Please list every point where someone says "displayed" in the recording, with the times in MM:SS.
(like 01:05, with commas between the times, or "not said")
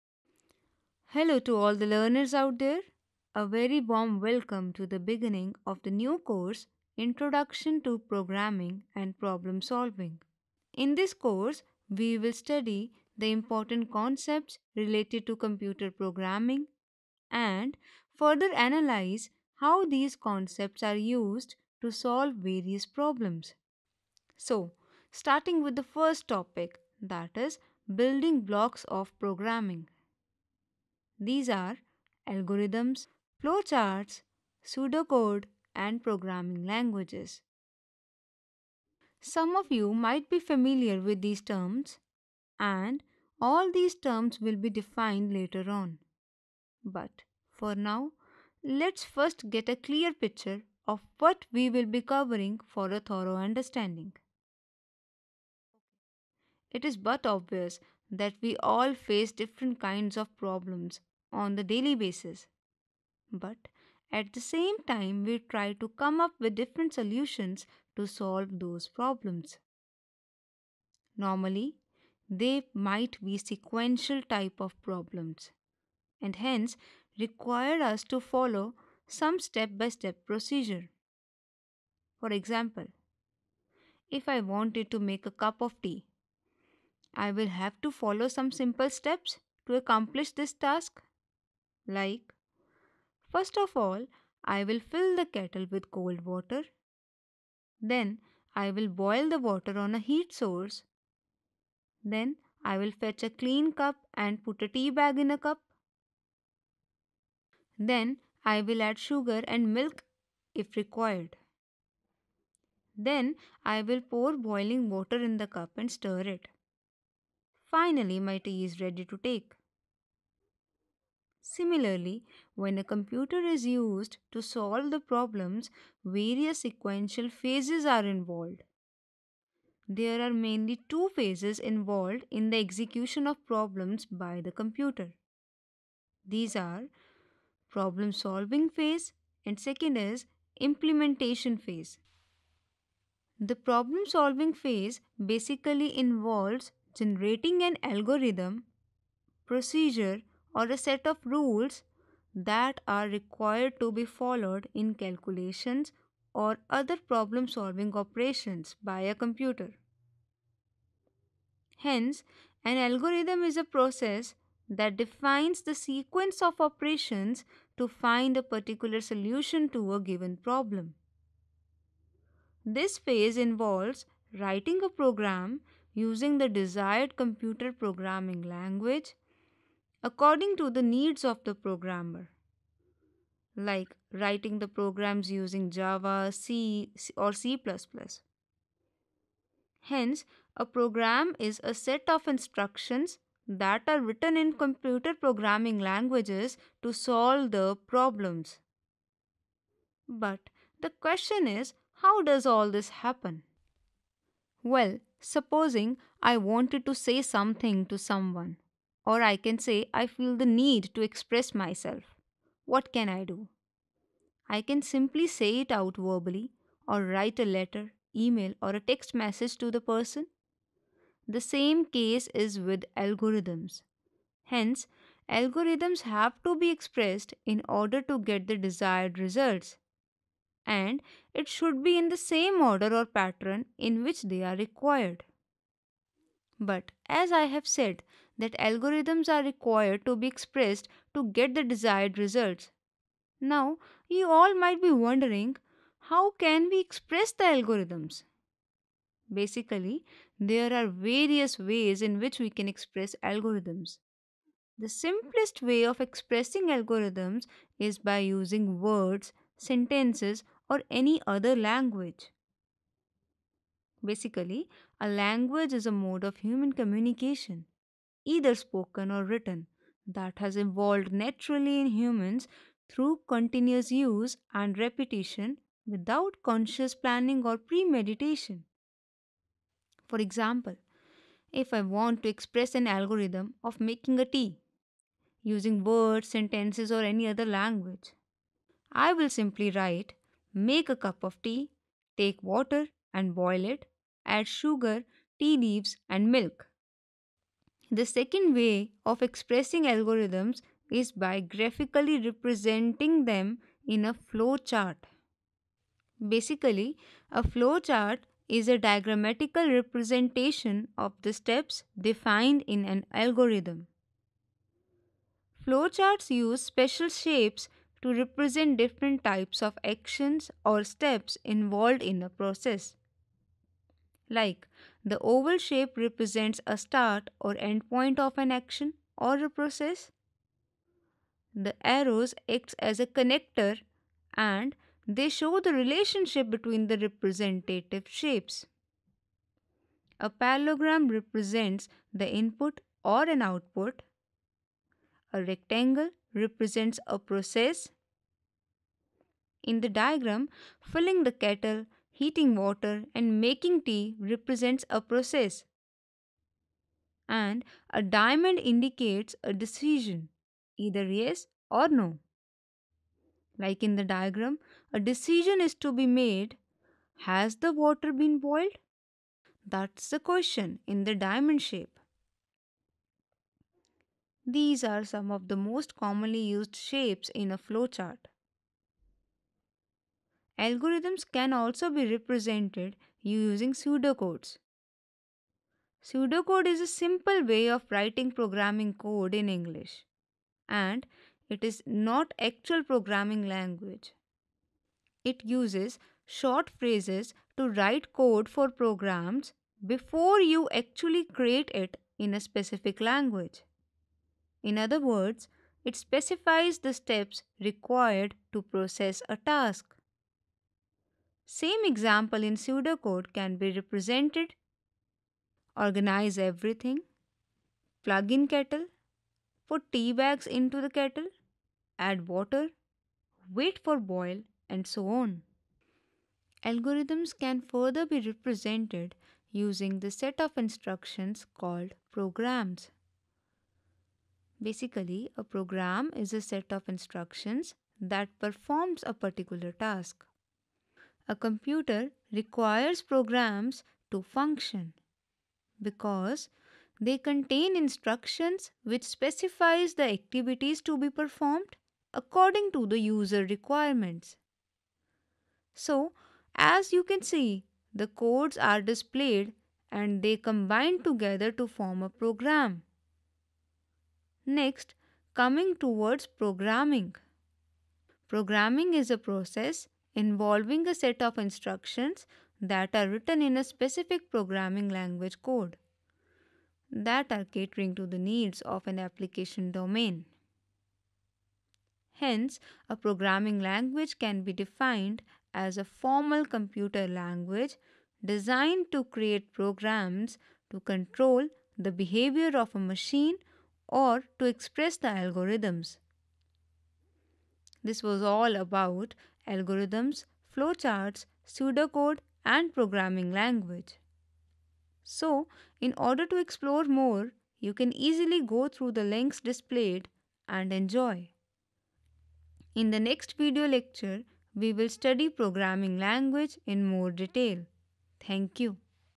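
07:38, 08:29.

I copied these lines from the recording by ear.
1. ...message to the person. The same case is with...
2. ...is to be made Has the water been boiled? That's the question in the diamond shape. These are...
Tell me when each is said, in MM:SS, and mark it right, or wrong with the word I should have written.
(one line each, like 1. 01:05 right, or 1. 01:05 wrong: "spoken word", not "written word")
1. 03:39 right
2. 06:05 right.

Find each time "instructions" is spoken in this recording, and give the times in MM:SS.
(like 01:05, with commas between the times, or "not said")
03:12, 07:10, 07:16, 07:27, 07:51.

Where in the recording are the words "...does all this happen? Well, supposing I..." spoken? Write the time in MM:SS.
03:22.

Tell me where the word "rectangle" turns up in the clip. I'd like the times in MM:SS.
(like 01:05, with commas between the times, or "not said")
05:45.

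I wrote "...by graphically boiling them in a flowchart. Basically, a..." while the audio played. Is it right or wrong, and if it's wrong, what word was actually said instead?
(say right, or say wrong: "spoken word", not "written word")
wrong: "representing", not "boiling".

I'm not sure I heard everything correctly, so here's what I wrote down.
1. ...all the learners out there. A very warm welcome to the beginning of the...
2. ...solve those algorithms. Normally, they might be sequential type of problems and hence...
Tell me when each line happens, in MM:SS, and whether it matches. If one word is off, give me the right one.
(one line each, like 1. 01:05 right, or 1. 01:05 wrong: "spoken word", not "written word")
1. 00:01 right
2. 01:08 wrong: "problems", not "algorithms".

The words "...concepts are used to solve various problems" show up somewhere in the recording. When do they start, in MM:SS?
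00:20.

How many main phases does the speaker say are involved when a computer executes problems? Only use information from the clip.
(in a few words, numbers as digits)
2.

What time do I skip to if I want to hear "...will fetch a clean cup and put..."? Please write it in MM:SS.
01:42.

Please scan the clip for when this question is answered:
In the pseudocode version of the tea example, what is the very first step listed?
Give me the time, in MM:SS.
06:55.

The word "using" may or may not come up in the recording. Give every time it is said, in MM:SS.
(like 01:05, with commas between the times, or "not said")
02:55, 03:05, 04:18, 04:45, 06:23, 07:09.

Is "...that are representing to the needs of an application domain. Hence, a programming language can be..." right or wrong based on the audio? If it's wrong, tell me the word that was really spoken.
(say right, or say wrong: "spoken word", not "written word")
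wrong: "catering", not "representing".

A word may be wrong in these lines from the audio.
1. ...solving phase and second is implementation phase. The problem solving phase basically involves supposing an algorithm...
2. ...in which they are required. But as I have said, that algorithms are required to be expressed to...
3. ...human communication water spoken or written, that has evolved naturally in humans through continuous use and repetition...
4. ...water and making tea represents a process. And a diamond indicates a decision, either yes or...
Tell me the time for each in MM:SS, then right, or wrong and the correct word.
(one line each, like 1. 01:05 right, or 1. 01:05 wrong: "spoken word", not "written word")
1. 02:18 wrong: "generating", not "supposing"
2. 03:53 right
3. 04:26 wrong: "either", not "water"
4. 05:52 right.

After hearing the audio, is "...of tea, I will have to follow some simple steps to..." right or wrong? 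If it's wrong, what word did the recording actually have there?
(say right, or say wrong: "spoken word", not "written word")
right.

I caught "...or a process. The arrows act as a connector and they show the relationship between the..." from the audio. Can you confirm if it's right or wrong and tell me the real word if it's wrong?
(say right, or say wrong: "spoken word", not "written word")
right.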